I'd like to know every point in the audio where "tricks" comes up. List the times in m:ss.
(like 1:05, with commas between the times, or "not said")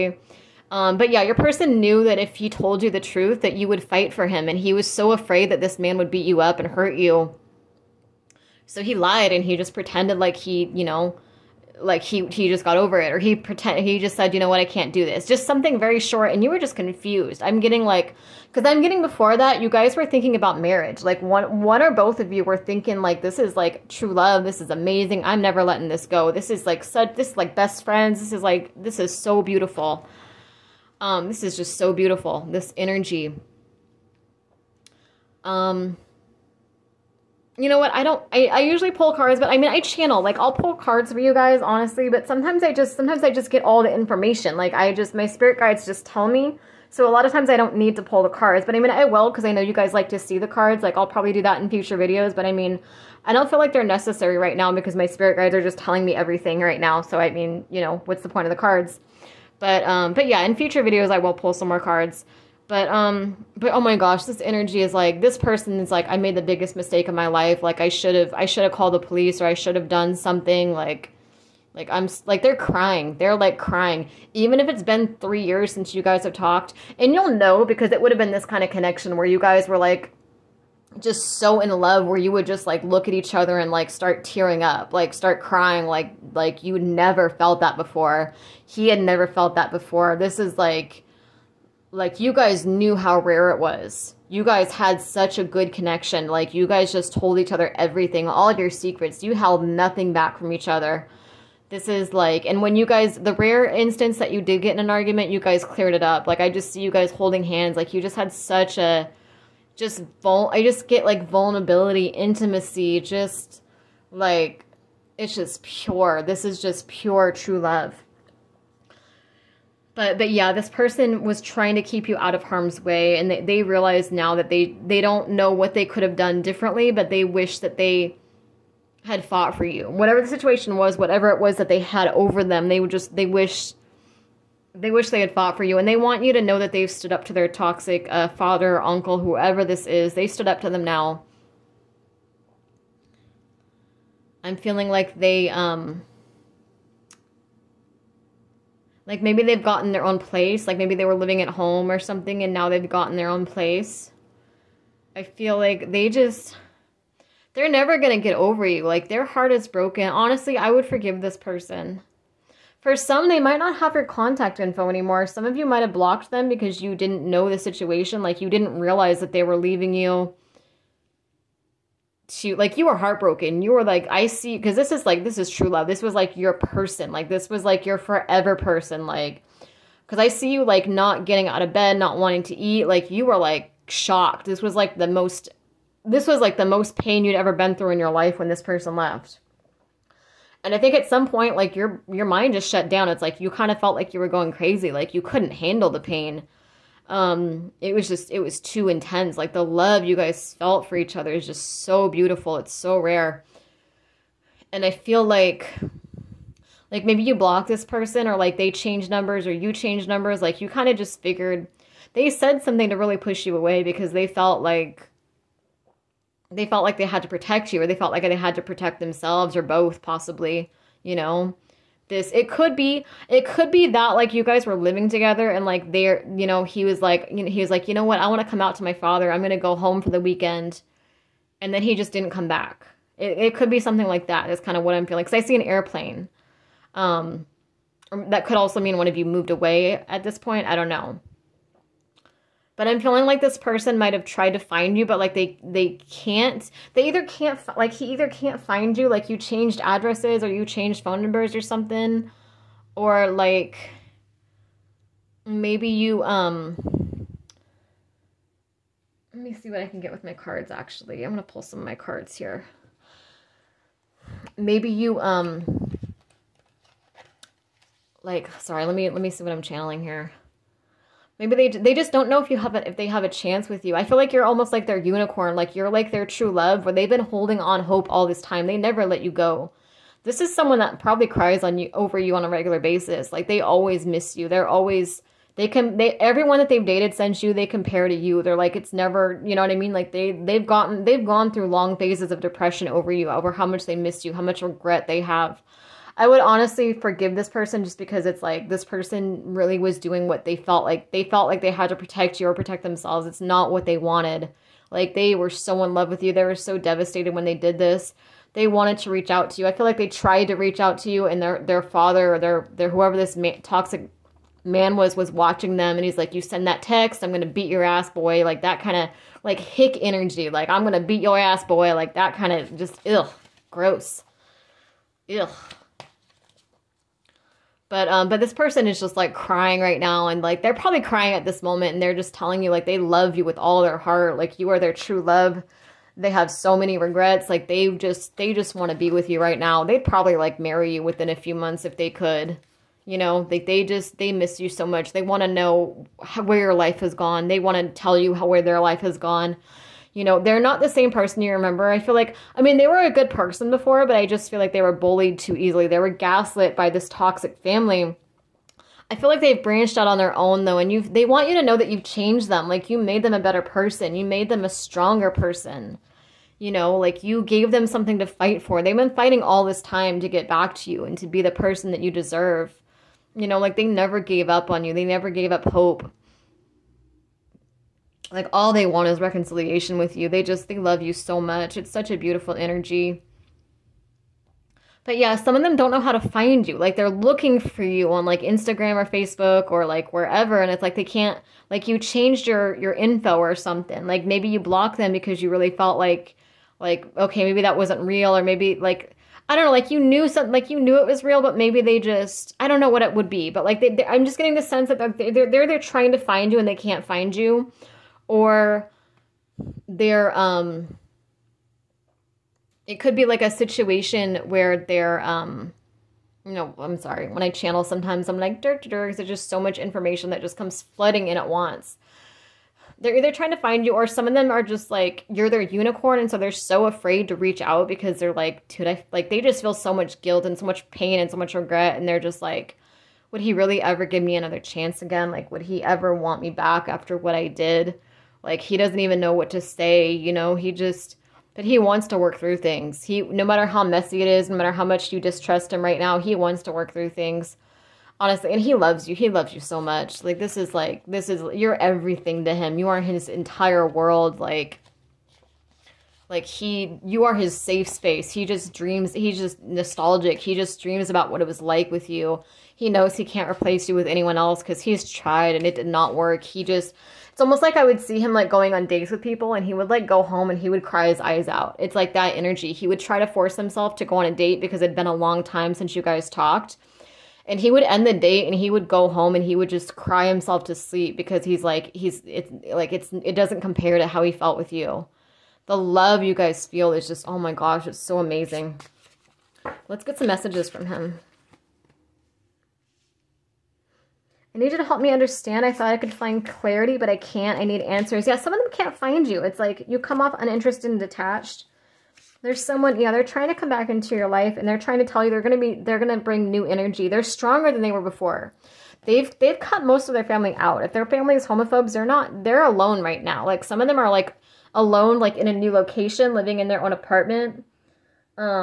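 not said.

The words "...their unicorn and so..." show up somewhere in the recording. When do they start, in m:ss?
7:05.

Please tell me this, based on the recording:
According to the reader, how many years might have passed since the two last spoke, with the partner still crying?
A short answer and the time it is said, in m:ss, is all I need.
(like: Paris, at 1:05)
3 years, at 1:15.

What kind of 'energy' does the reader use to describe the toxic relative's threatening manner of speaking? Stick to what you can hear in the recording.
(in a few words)
Hick energy.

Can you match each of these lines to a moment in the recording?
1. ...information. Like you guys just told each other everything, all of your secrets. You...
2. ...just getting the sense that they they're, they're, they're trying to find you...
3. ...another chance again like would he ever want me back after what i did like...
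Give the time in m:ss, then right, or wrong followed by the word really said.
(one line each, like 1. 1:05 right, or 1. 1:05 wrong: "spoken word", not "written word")
1. 1:35 wrong: "connection", not "information"
2. 6:44 right
3. 7:14 right.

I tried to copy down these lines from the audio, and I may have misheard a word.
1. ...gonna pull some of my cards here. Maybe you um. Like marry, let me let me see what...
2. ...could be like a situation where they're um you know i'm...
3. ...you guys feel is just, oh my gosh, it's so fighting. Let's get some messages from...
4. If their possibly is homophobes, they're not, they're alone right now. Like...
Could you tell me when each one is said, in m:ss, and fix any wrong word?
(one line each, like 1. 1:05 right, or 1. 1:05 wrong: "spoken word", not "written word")
1. 4:21 wrong: "sorry", not "marry"
2. 6:53 right
3. 8:06 wrong: "amazing", not "fighting"
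4. 8:30 wrong: "family", not "possibly".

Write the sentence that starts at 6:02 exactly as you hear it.
Like you made them a better person.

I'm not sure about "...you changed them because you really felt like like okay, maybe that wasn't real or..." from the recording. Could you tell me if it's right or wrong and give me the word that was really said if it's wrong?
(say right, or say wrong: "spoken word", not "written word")
wrong: "blocked", not "changed".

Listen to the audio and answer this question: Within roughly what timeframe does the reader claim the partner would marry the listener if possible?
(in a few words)
A few months.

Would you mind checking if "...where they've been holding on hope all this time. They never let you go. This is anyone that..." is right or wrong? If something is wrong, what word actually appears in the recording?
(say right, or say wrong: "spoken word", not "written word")
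wrong: "someone", not "anyone".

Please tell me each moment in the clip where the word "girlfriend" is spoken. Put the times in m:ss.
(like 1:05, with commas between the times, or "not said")
not said.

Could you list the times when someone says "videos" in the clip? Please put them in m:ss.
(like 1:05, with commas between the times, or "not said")
0:51, 1:00.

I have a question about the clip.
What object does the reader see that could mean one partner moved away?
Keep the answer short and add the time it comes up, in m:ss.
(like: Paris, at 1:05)
An airplane, at 3:55.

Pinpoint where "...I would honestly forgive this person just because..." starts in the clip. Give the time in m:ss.
4:56.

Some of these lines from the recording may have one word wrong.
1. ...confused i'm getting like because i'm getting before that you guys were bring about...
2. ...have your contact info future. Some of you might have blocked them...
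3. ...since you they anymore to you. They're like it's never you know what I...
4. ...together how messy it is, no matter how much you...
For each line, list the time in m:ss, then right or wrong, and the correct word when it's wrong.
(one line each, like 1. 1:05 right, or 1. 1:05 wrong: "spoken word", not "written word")
1. 0:16 wrong: "thinking", not "bring"
2. 2:43 wrong: "anymore", not "future"
3. 4:47 wrong: "compare", not "anymore"
4. 7:23 wrong: "matter", not "together".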